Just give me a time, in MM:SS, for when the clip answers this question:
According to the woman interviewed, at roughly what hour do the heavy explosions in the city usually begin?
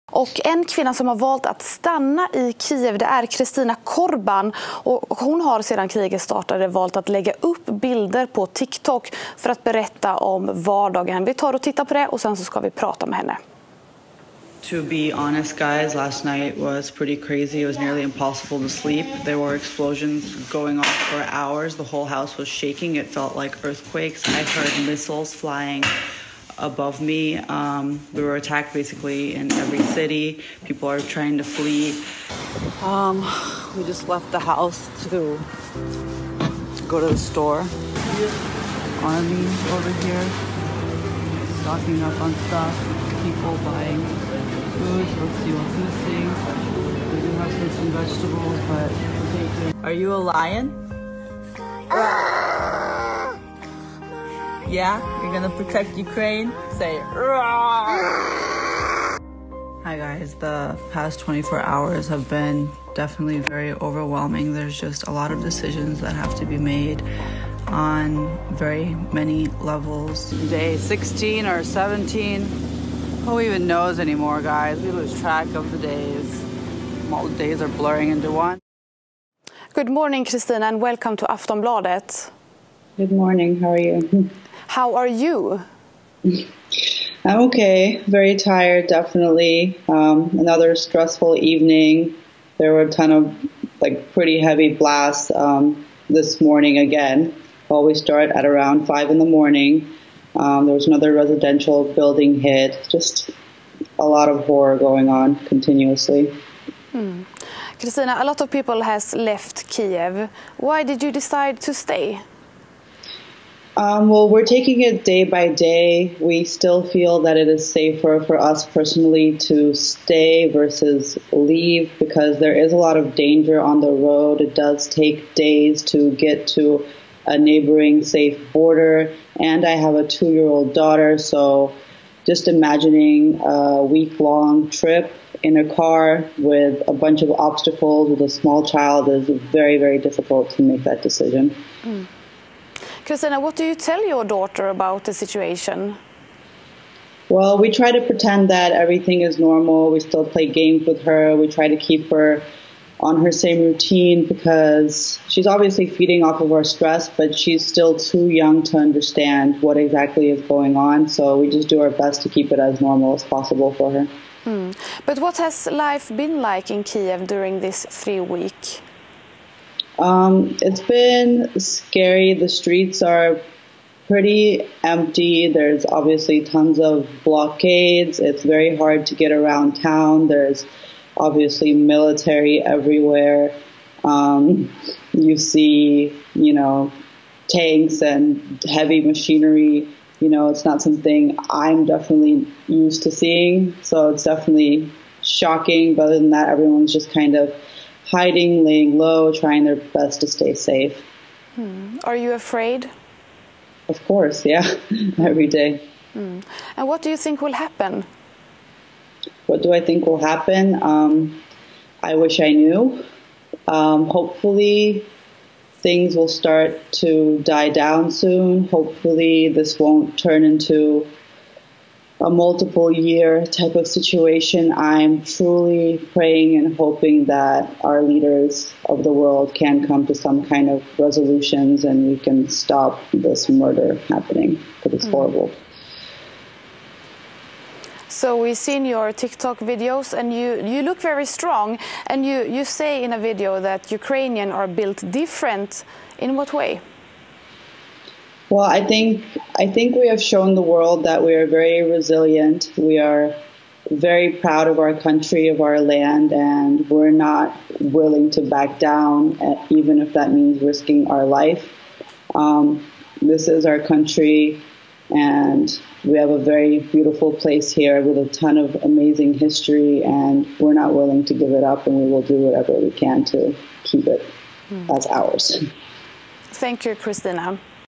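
01:38.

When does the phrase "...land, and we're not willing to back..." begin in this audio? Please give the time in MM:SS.
04:15.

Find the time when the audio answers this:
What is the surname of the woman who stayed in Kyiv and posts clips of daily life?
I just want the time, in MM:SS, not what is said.
00:03.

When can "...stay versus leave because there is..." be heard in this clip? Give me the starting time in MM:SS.
01:59.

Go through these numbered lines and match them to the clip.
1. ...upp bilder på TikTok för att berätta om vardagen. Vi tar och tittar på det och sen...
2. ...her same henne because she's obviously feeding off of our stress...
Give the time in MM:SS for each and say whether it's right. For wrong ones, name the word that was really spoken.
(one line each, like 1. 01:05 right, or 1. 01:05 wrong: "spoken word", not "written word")
1. 00:07 right
2. 02:33 wrong: "routine", not "henne".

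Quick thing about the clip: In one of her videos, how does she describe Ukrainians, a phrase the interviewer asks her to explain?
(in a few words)
Built different.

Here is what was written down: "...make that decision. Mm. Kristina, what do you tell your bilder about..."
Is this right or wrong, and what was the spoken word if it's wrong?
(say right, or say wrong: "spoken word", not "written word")
wrong: "daughter", not "bilder".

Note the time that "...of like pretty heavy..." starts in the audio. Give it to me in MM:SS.
01:33.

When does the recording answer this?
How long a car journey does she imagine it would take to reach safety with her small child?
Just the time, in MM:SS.
02:13.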